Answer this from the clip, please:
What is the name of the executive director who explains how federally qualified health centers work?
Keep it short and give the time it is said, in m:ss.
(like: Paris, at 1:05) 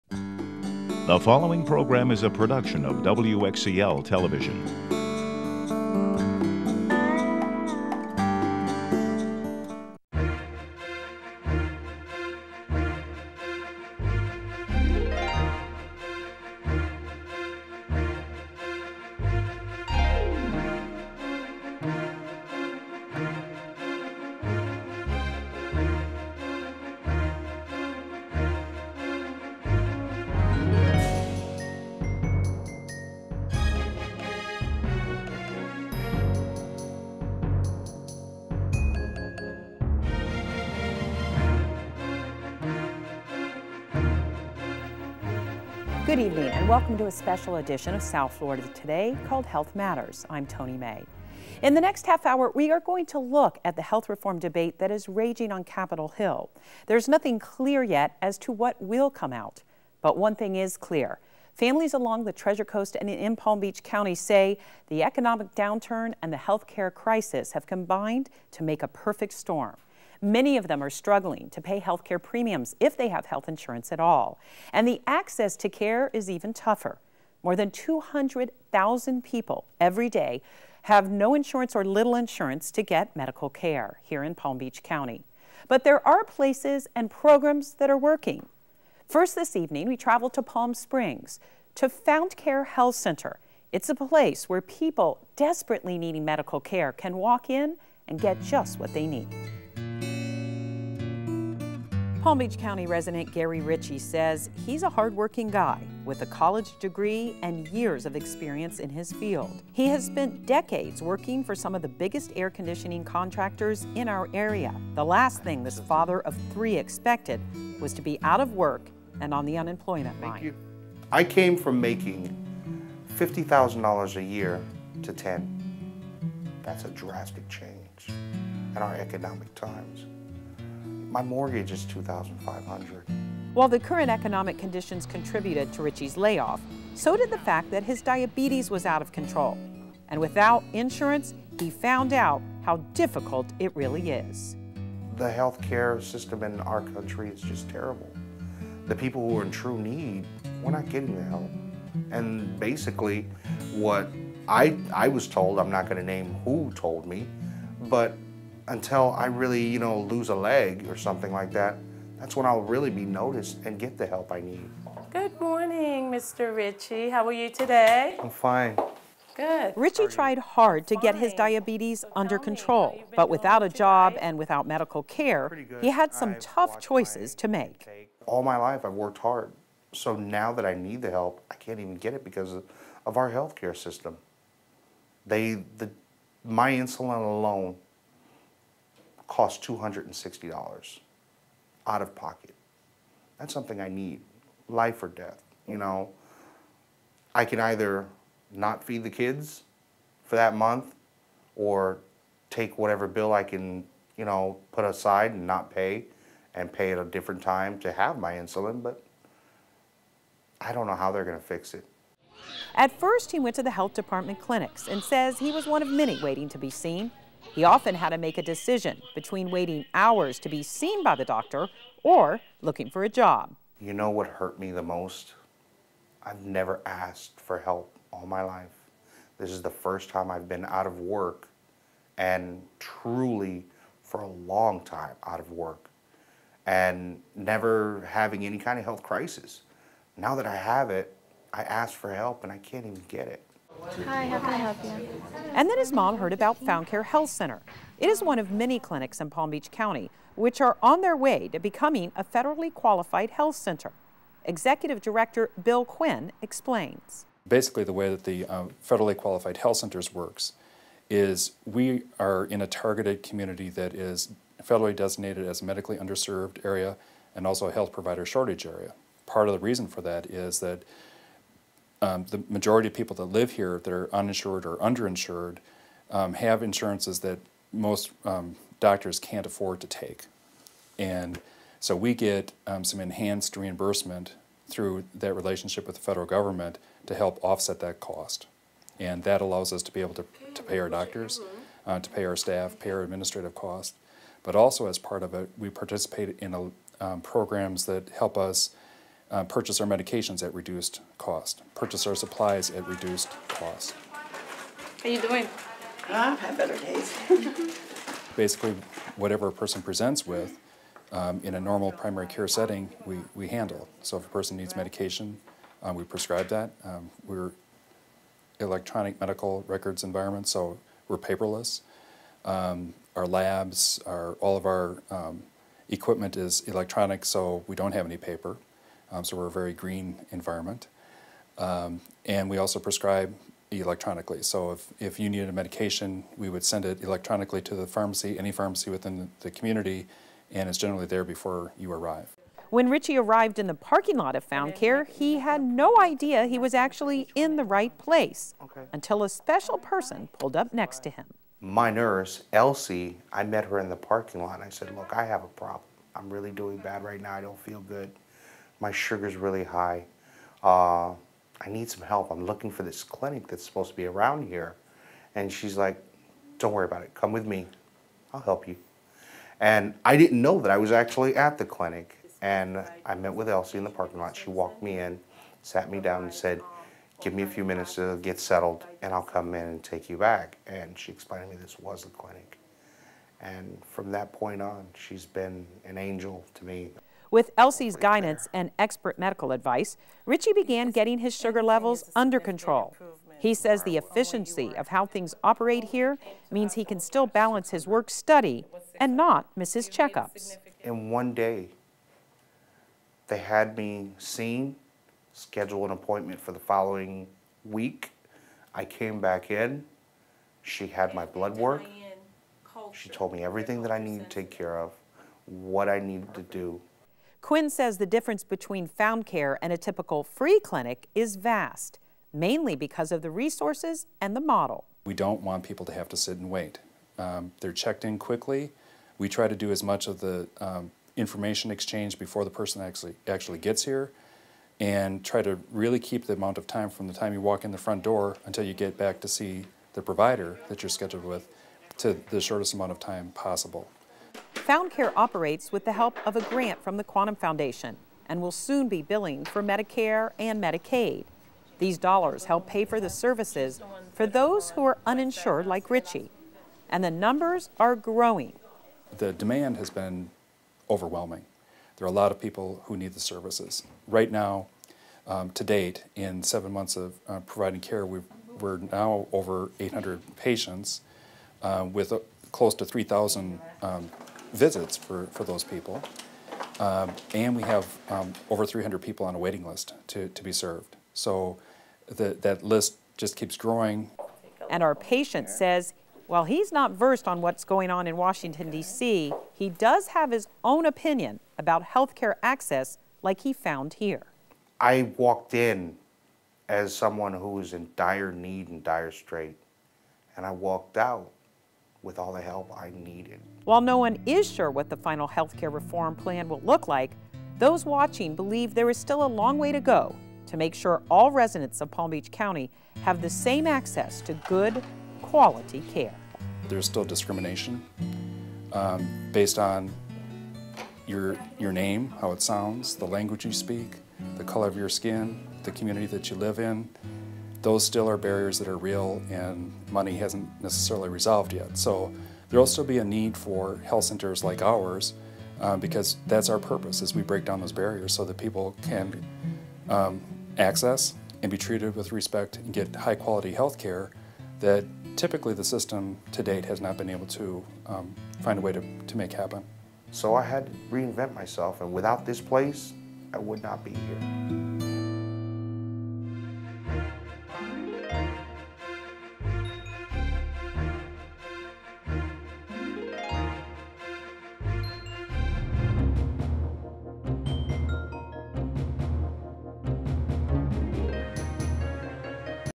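Bill Quinn, at 4:15.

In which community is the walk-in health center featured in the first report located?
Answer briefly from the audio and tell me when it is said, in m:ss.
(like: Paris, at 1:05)
Palm Springs, at 1:30.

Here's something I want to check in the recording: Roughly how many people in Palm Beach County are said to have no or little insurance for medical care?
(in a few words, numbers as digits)
200,000.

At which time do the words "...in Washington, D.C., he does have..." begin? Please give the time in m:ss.
8:08.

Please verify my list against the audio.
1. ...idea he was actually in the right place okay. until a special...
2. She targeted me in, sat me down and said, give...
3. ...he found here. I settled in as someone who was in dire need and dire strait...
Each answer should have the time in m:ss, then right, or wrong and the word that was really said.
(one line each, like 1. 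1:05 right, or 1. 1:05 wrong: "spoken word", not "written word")
1. 5:45 right
2. 6:14 wrong: "walked", not "targeted"
3. 8:13 wrong: "walked", not "settled".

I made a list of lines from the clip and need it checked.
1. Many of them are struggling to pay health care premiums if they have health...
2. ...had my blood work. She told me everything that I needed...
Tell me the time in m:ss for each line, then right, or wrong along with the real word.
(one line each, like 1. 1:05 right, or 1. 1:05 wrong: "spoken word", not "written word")
1. 1:10 right
2. 6:50 right.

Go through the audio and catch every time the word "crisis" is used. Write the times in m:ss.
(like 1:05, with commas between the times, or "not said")
1:06, 3:59.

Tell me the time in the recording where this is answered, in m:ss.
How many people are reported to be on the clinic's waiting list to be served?
7:58.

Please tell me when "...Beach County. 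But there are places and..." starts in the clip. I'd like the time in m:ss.
1:24.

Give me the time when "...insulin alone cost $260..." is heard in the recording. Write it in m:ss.
3:06.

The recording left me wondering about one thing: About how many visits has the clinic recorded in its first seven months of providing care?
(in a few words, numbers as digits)
3,000.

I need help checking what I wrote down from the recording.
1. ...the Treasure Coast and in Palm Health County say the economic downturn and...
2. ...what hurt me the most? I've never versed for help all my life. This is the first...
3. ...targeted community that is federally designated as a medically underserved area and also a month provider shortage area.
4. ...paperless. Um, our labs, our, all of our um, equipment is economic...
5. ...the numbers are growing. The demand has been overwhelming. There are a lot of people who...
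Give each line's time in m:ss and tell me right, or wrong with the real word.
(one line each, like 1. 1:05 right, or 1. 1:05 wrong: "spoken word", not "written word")
1. 1:02 wrong: "Beach", not "Health"
2. 3:44 wrong: "asked", not "versed"
3. 4:22 wrong: "health", not "month"
4. 5:21 wrong: "electronic", not "economic"
5. 7:37 right.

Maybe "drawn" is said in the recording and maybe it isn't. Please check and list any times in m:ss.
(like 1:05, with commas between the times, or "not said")
not said.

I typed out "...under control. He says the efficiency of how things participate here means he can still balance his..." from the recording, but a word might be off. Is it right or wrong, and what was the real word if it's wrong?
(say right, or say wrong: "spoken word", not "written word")
wrong: "operate", not "participate".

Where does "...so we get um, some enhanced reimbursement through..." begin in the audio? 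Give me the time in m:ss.
4:41.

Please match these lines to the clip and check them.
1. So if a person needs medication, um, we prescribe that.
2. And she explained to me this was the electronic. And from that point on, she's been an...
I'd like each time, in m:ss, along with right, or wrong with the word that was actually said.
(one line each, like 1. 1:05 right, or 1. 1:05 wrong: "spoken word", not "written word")
1. 5:14 right
2. 6:20 wrong: "clinic", not "electronic".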